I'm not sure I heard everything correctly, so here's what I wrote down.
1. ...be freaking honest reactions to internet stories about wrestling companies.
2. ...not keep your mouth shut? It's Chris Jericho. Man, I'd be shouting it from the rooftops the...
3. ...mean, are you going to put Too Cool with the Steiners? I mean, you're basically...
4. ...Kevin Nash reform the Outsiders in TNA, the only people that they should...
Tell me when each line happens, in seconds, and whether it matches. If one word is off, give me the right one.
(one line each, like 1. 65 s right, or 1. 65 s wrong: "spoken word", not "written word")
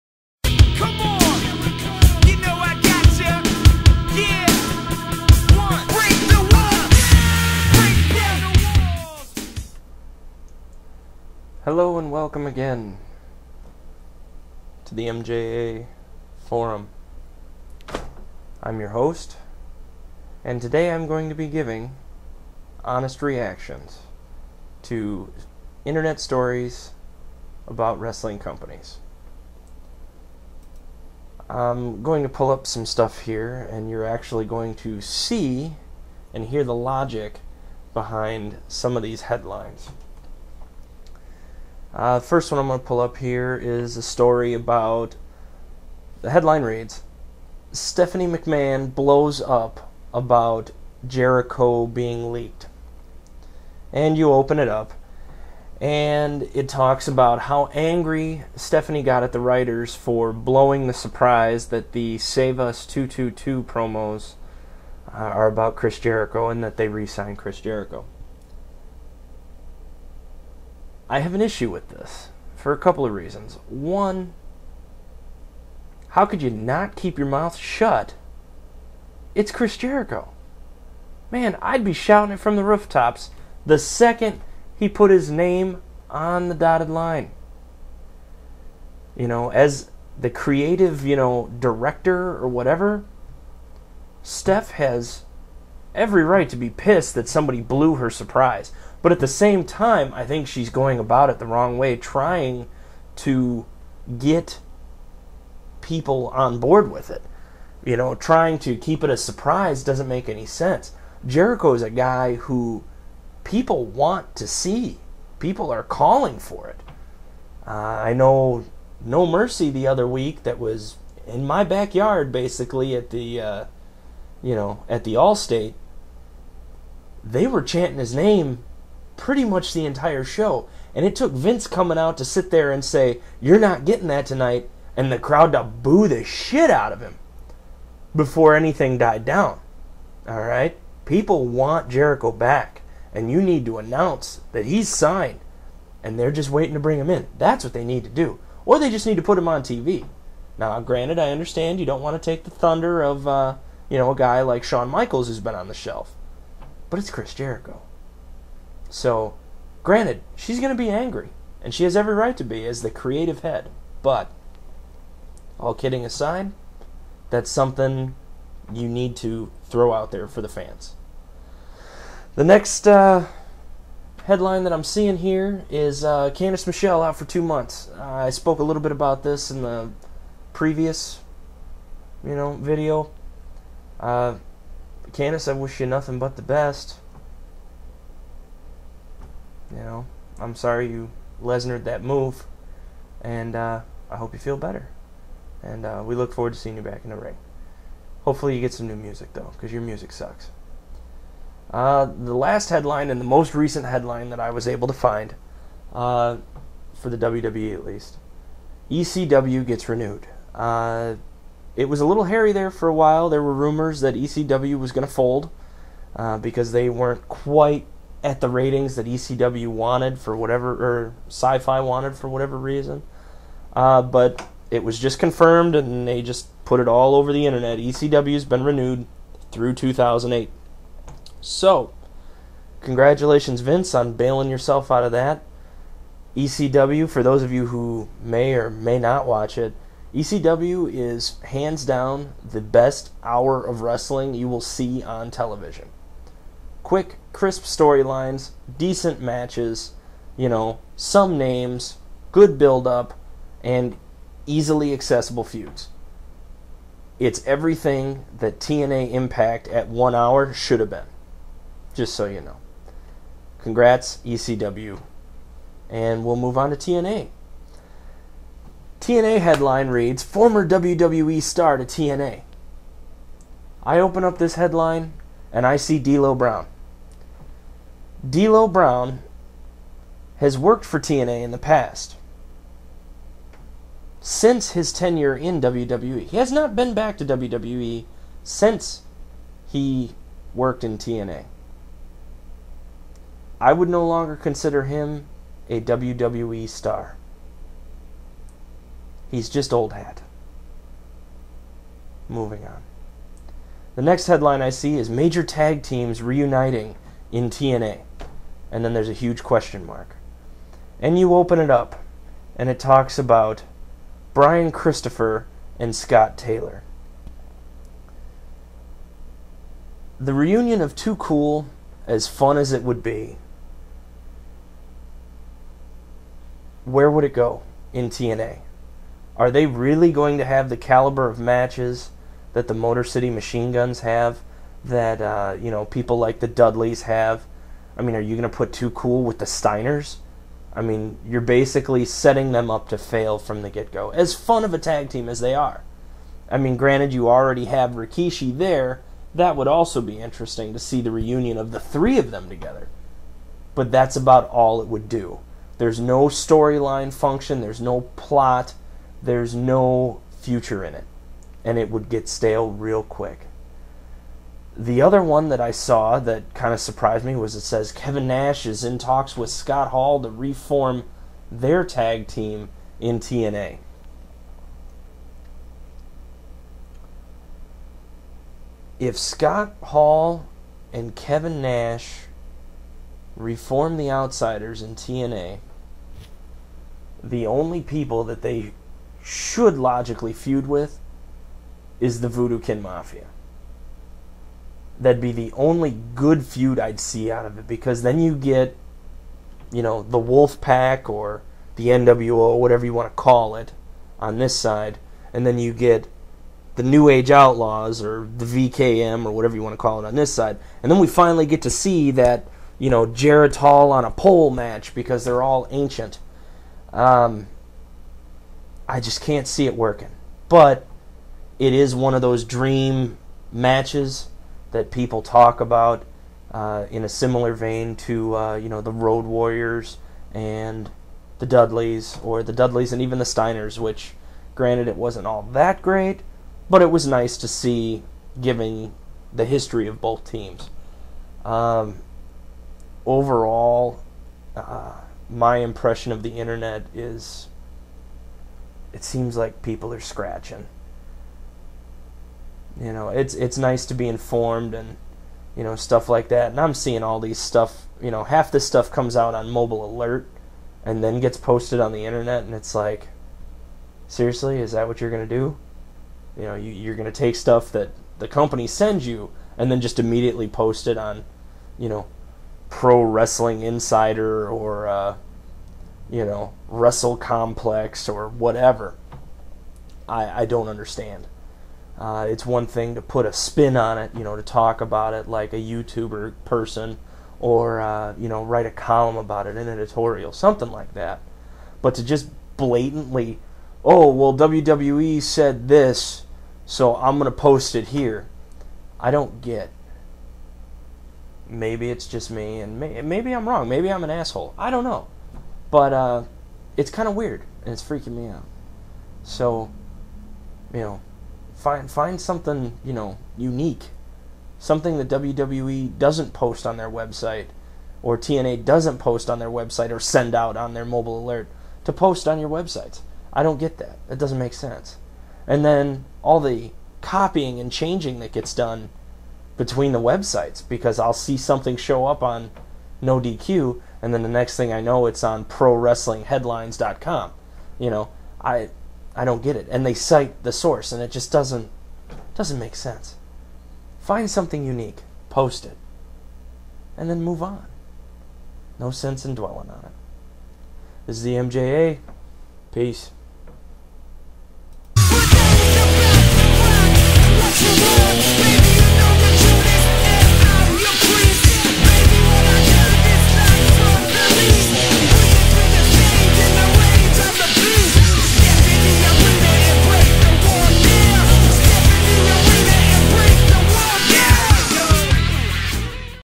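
1. 21 s wrong: "giving", not "freaking"
2. 76 s right
3. 338 s right
4. 381 s right.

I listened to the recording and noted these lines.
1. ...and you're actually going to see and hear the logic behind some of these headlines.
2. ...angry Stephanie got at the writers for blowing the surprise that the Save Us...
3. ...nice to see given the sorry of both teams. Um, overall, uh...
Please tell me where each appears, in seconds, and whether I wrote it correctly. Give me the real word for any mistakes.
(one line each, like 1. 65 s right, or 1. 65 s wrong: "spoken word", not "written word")
1. 33 s right
2. 57 s right
3. 437 s wrong: "history", not "sorry".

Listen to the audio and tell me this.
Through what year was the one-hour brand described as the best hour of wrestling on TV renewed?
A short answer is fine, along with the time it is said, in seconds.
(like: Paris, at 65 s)
2008, at 229 s.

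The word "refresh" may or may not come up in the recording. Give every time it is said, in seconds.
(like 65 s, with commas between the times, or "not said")
not said.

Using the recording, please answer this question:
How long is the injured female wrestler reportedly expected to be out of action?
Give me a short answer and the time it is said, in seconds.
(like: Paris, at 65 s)
two months, at 177 s.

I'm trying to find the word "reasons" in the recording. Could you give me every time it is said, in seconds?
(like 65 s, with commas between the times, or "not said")
73 s, 222 s.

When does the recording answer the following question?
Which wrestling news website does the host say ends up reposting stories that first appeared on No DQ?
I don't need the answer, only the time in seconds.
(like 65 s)
535 s.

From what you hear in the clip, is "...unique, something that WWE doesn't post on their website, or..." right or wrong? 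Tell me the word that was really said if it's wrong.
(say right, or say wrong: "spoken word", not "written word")
right.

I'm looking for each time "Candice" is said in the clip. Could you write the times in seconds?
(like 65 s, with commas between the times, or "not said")
176 s, 185 s.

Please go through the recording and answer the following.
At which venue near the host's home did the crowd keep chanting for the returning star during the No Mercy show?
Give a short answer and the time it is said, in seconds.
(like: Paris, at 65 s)
the Allstate, at 125 s.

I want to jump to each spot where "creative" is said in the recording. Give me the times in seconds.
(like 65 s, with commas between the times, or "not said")
90 s, 162 s.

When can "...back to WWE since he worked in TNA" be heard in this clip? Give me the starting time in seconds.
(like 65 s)
286 s.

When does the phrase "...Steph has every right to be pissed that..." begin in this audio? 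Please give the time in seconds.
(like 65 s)
94 s.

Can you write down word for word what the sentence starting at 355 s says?
There's no storyline function, there's no plot, there's no future in it, and it would get stale real quick.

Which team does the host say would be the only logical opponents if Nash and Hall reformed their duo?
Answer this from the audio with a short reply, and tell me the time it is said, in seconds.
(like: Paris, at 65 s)
Voodoo Kin Mafia, at 392 s.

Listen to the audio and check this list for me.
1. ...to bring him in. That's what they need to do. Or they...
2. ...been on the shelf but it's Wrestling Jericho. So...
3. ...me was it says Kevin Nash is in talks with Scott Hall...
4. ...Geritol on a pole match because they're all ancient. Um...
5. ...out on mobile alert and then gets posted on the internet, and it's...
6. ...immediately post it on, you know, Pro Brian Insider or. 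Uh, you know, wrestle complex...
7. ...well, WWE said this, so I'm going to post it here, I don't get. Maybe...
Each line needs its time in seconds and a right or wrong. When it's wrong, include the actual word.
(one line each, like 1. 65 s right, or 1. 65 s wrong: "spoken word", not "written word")
1. 146 s right
2. 155 s wrong: "Chris", not "Wrestling"
3. 367 s right
4. 413 s right
5. 459 s right
6. 469 s wrong: "Wrestling", not "Brian"
7. 494 s right.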